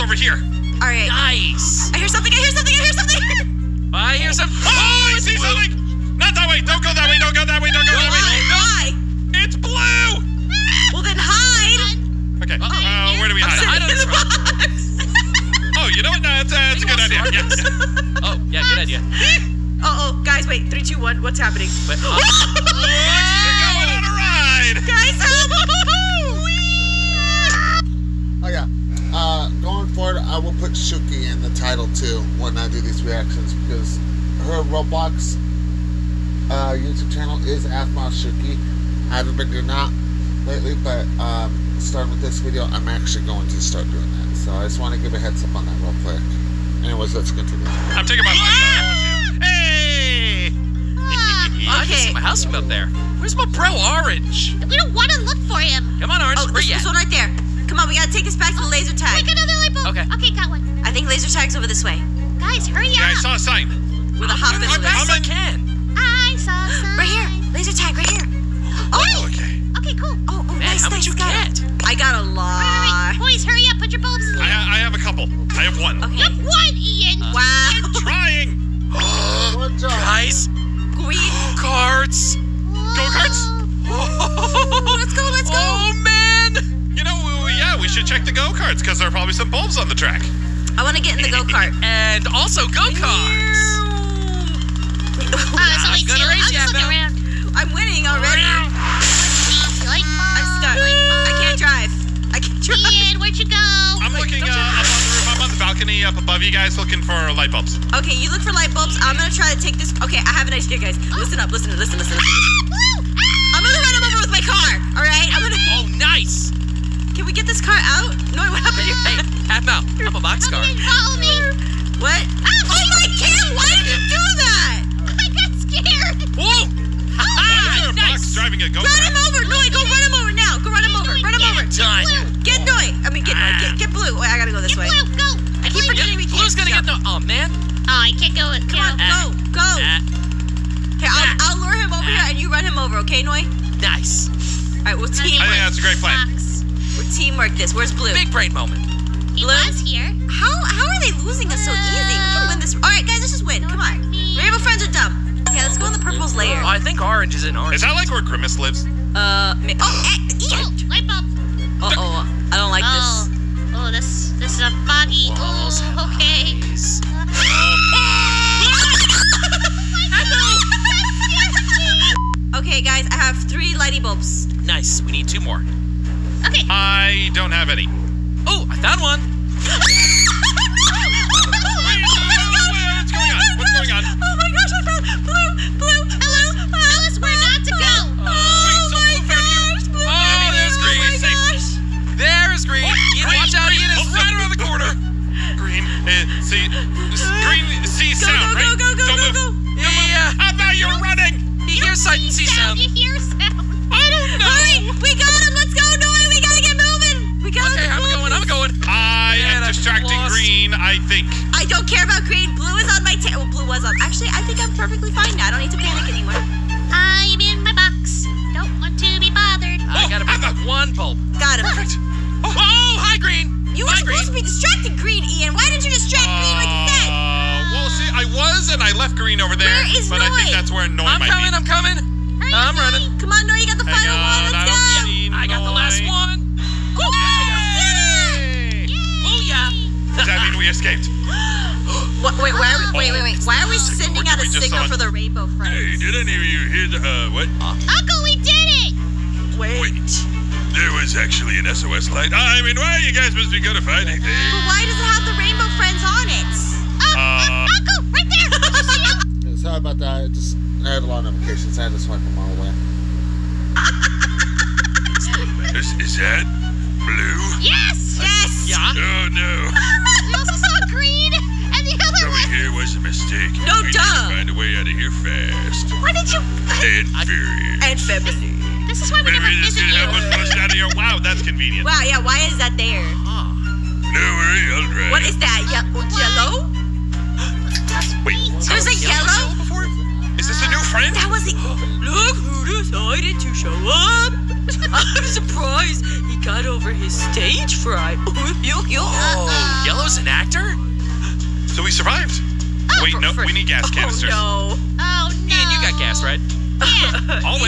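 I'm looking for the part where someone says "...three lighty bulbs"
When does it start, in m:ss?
2:53.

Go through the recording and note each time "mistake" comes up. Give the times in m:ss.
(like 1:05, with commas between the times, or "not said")
4:33.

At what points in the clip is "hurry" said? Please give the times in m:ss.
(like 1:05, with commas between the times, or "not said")
1:02, 1:13.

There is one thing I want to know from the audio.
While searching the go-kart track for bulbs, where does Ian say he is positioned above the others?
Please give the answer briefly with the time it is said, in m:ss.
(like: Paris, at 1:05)
On the balcony, at 1:45.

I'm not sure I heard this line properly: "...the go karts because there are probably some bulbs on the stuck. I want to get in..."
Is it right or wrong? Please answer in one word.
wrong.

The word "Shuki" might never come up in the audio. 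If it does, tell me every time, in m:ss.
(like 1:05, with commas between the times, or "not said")
0:30.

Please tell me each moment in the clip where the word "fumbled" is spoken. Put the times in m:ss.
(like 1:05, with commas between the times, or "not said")
not said.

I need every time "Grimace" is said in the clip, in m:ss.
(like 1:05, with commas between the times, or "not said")
2:38.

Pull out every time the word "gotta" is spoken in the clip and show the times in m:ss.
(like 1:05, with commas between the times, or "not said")
0:57, 2:14.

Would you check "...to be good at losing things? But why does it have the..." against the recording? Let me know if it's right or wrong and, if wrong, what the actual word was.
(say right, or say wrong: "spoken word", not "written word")
wrong: "finding", not "losing".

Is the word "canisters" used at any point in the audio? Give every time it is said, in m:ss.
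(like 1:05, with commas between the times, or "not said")
5:03.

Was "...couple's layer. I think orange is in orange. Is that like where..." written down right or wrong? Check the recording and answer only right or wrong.
wrong.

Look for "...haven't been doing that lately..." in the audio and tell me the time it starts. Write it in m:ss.
0:39.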